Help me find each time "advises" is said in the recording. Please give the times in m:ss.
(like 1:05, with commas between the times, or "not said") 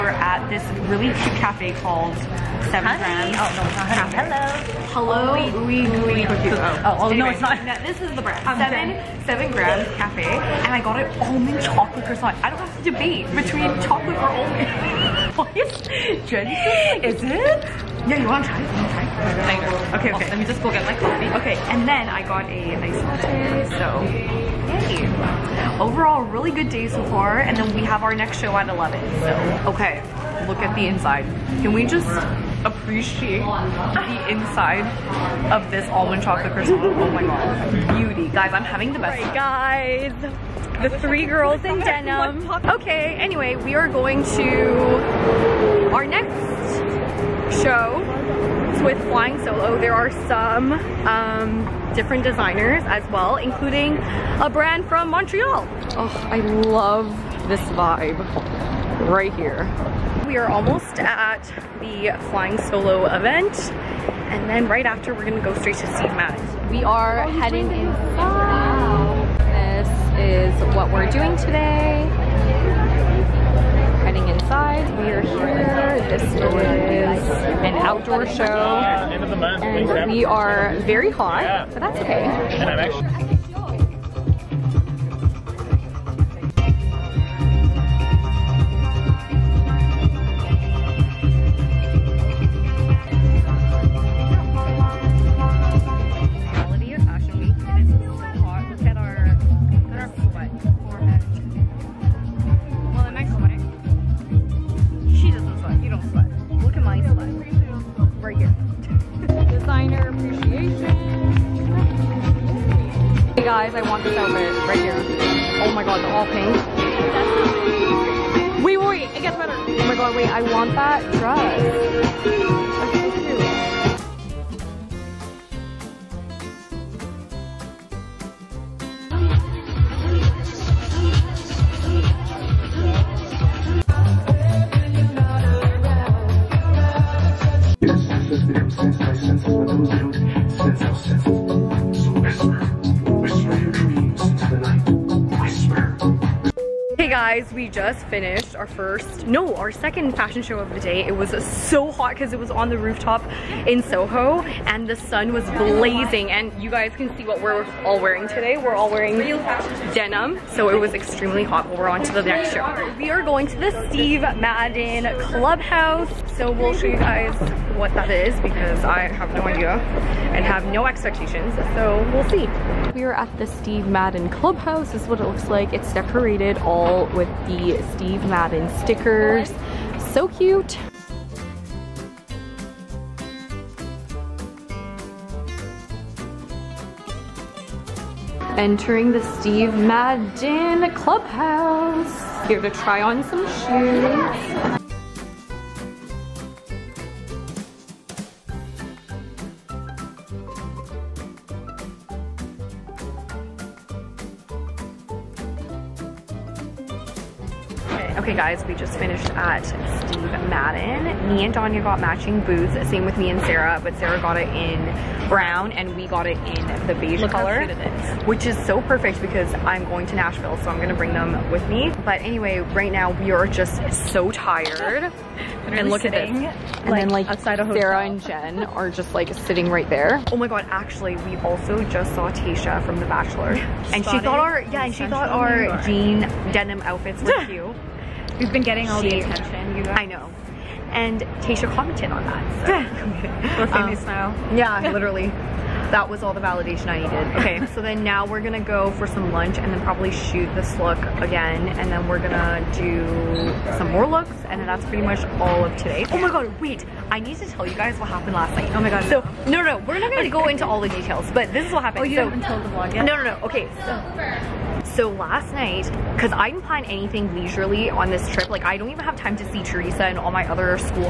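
not said.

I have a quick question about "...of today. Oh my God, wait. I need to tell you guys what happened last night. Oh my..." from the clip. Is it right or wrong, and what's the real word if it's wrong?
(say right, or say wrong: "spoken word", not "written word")
right.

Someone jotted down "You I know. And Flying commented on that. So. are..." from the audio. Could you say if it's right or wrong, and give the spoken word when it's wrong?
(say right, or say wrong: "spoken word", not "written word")
wrong: "Tasha", not "Flying".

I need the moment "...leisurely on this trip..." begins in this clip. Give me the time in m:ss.
4:27.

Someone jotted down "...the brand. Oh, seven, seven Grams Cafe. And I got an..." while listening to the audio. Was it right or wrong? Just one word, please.
right.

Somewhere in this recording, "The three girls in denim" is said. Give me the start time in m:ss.
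0:40.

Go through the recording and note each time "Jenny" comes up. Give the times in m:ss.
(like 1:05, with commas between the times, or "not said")
0:16.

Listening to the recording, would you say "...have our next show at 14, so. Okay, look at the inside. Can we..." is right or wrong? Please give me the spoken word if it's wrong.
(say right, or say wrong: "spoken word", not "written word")
wrong: "11", not "14".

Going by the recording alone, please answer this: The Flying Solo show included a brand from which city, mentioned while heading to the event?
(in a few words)
Montreal.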